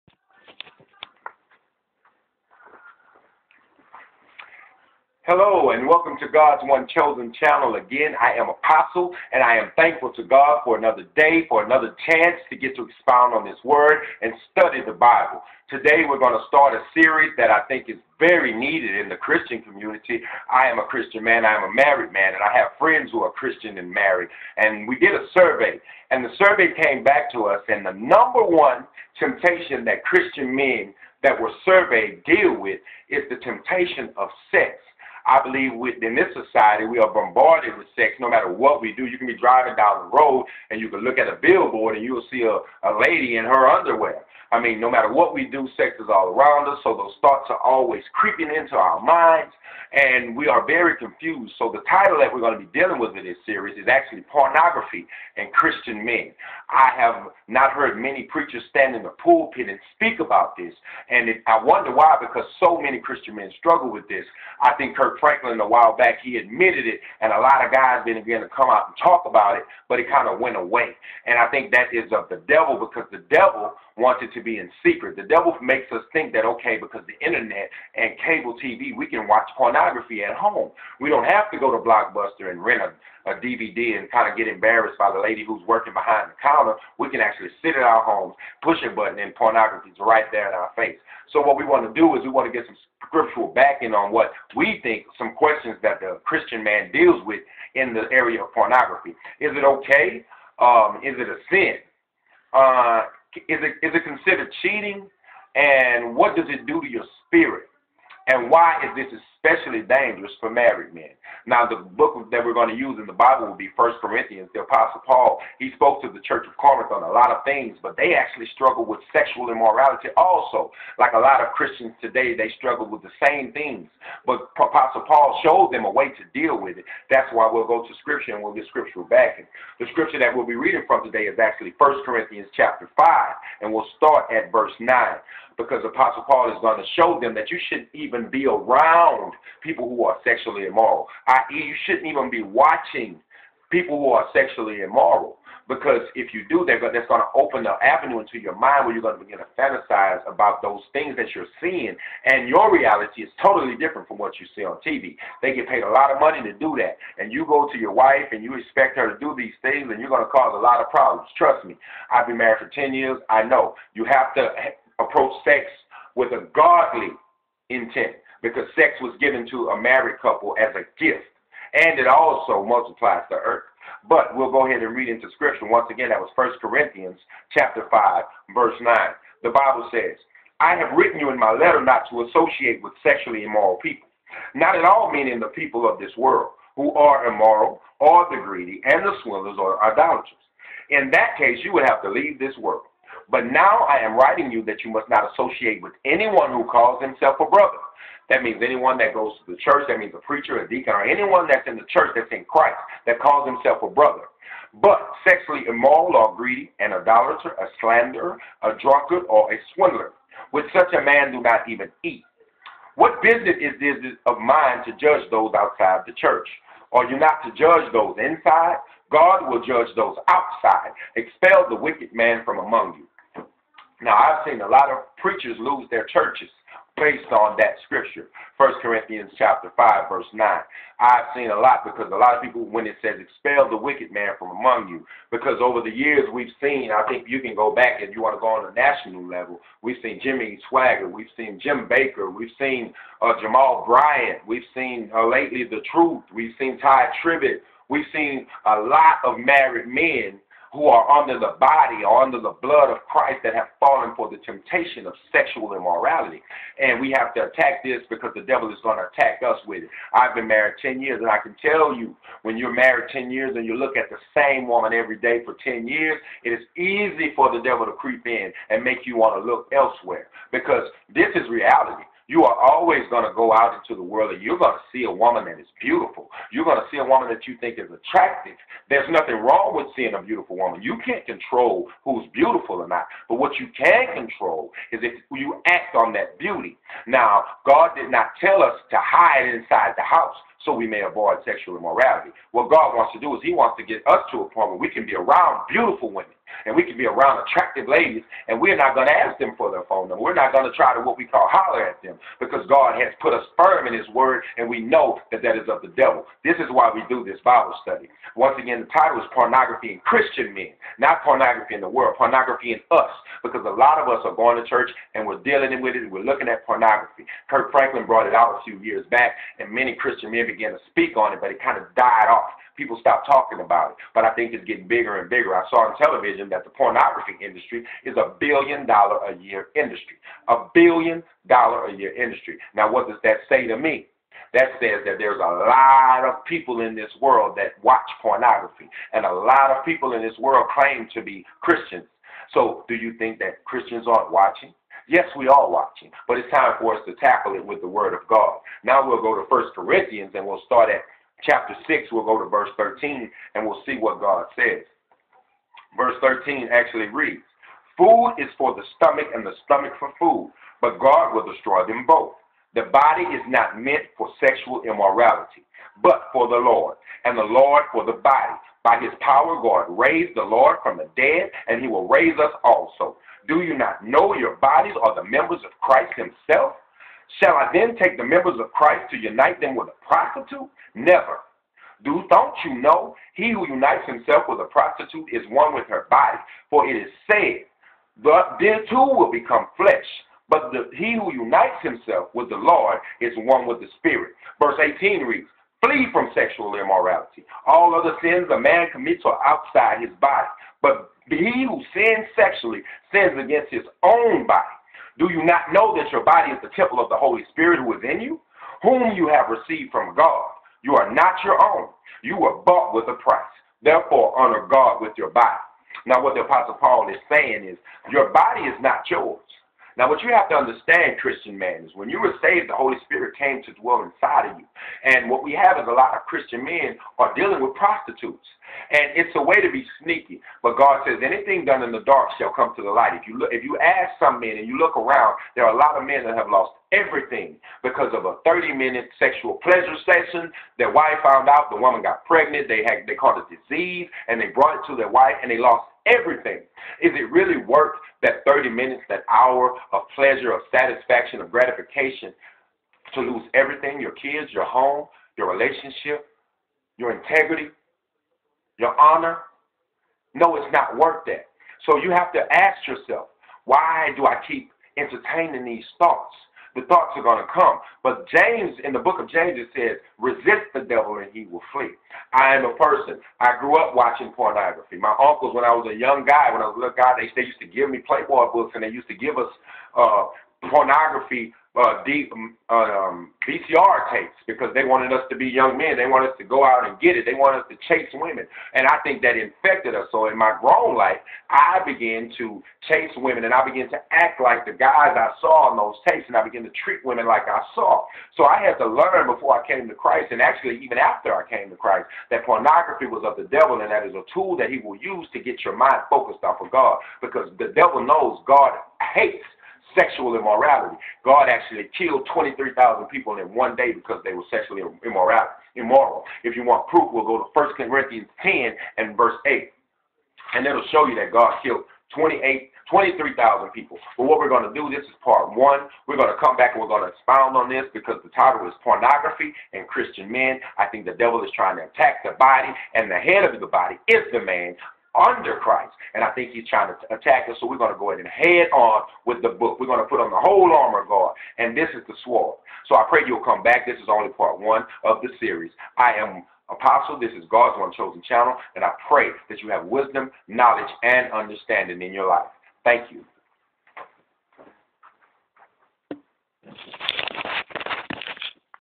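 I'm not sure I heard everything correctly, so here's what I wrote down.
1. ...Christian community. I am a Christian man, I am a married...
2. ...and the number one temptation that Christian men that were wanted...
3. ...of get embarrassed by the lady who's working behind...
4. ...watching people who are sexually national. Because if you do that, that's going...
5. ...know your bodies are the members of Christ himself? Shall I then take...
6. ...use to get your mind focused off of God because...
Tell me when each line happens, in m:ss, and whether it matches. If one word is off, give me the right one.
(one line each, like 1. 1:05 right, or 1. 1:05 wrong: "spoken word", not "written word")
1. 0:19 right
2. 0:27 wrong: "surveyed", not "wanted"
3. 1:24 right
4. 2:22 wrong: "immoral", not "national"
5. 6:14 right
6. 8:24 right.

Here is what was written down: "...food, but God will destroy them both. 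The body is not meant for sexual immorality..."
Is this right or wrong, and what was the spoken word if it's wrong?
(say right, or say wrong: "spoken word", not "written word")
right.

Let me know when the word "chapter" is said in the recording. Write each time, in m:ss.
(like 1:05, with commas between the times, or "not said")
2:12, 2:57, 3:49, 5:51.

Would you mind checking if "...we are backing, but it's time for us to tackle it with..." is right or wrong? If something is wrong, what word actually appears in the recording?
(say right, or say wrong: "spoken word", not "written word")
wrong: "watching", not "backing".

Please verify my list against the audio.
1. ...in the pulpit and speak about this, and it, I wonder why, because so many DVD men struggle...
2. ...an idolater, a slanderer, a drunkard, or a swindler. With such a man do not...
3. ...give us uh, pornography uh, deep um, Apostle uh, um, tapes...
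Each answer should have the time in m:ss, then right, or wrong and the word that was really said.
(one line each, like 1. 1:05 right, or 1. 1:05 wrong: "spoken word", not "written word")
1. 0:58 wrong: "Christian", not "DVD"
2. 3:26 right
3. 7:59 wrong: "VCR", not "Apostle".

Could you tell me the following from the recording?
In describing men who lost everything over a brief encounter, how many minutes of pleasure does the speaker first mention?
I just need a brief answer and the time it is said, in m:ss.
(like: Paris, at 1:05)
30 minutes, at 7:18.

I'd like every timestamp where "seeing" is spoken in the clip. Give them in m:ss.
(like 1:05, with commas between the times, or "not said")
2:31, 4:39.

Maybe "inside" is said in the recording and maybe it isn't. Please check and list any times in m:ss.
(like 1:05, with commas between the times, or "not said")
3:38, 4:49, 7:04.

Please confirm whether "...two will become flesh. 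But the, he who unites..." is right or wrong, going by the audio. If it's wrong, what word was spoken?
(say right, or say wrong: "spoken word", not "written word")
right.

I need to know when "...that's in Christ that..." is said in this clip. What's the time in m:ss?
3:22.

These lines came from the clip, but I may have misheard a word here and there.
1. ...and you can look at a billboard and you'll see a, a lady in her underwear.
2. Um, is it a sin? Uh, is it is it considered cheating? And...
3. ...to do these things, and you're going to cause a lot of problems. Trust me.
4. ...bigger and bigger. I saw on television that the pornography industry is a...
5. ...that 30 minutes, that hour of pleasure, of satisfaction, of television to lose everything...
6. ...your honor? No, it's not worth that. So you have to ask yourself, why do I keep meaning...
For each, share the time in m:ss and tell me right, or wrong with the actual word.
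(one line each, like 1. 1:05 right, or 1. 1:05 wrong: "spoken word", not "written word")
1. 0:40 right
2. 1:40 right
3. 2:39 right
4. 5:24 right
5. 7:28 wrong: "gratification", not "television"
6. 7:38 wrong: "entertaining", not "meaning".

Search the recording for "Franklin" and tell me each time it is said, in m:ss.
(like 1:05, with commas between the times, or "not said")
1:05, 5:17.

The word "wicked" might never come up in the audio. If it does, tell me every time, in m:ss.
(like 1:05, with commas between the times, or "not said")
3:41, 3:53.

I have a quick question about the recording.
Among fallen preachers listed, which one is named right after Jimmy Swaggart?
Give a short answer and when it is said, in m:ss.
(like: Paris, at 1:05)
Jim Bakker, at 4:01.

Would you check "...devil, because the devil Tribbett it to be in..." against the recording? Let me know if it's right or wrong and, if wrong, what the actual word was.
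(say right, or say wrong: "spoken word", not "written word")
wrong: "Wanted", not "Tribbett".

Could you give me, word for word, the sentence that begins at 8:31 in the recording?
God actually killed 23,000 people in one day because they were sexually immoral.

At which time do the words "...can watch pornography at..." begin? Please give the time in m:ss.
1:19.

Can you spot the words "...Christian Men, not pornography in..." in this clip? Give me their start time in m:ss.
5:09.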